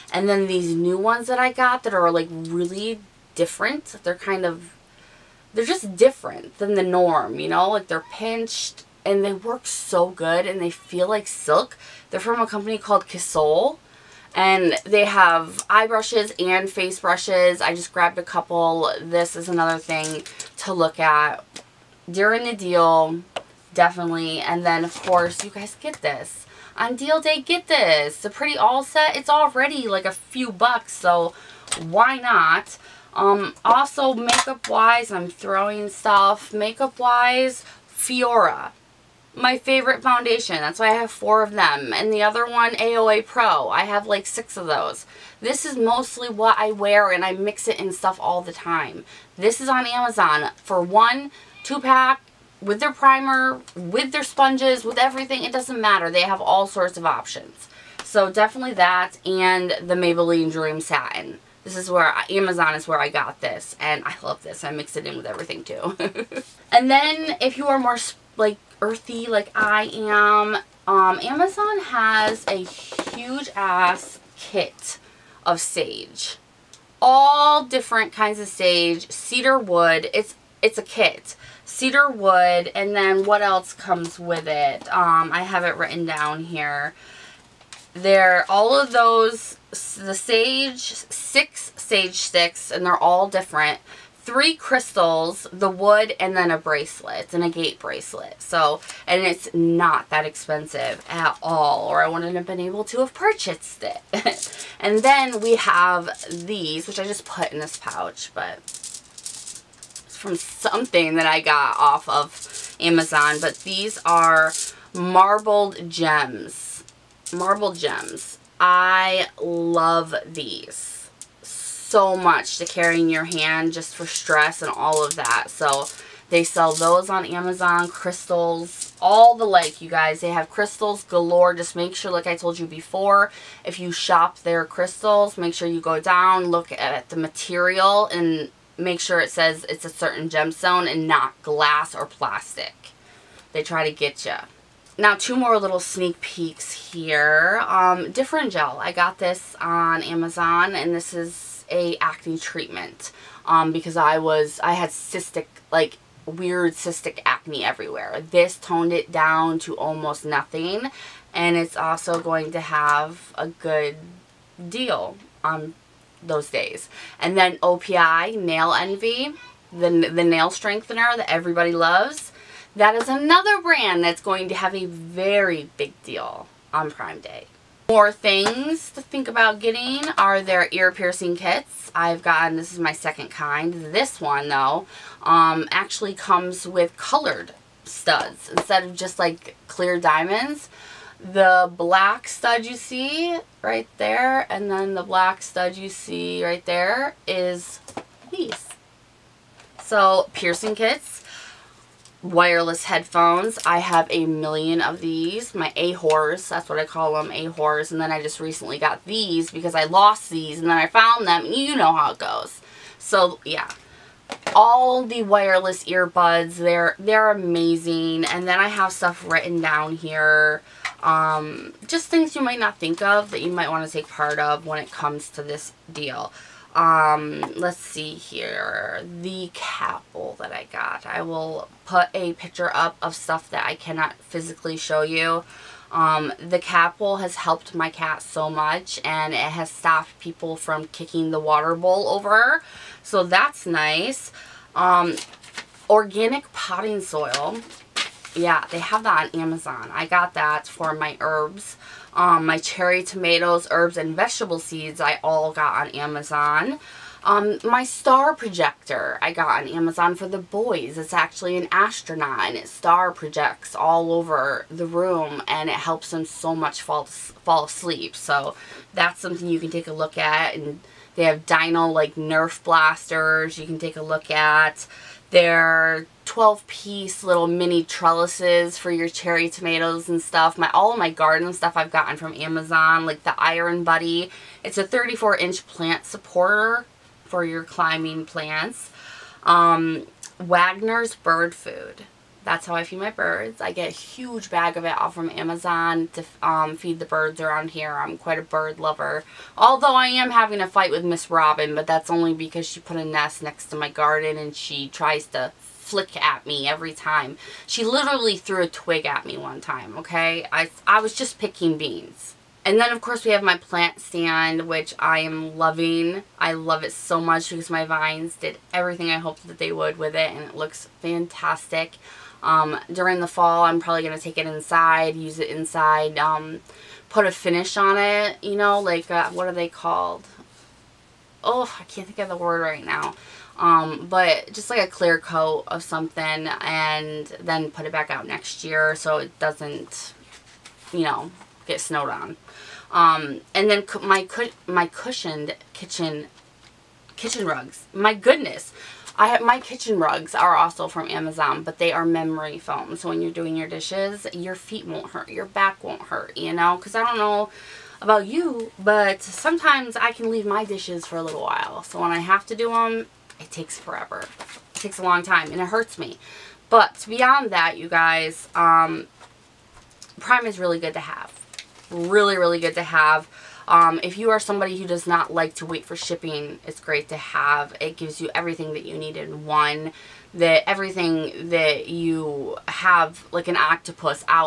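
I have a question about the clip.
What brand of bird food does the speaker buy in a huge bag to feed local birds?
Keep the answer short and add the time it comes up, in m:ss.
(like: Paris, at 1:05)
Wagner's, at 4:50.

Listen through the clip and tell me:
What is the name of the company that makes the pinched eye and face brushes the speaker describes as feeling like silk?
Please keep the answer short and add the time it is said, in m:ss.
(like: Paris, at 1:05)
Kissoul, at 0:13.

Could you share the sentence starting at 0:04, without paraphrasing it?
They're kind of, they're just different than the norm, you know?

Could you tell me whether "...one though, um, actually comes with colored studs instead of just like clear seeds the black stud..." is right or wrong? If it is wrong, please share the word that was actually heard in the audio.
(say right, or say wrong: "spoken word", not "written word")
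wrong: "diamonds", not "seeds".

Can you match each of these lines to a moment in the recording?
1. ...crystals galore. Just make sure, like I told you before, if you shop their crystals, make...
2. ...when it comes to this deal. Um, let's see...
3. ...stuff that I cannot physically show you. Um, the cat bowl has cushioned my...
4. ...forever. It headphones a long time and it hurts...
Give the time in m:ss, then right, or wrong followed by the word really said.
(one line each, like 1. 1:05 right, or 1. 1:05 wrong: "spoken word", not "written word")
1. 2:10 right
2. 3:44 right
3. 3:53 wrong: "helped", not "cushioned"
4. 6:03 wrong: "takes", not "headphones".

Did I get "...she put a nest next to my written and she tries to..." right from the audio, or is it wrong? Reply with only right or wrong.
wrong.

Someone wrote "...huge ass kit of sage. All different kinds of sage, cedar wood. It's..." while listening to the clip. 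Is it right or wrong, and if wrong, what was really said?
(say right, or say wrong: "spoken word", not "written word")
right.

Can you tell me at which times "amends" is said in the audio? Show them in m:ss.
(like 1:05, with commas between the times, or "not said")
not said.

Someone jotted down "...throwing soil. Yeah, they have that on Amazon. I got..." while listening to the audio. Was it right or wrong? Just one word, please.
wrong.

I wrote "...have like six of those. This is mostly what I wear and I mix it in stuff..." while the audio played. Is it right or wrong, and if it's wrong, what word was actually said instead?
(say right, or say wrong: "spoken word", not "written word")
right.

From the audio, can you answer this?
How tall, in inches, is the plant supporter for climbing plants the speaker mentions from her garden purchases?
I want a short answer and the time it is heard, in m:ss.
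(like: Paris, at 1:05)
34, at 4:44.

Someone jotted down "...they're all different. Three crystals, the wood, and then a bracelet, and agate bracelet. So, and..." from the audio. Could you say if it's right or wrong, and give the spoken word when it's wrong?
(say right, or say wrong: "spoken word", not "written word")
right.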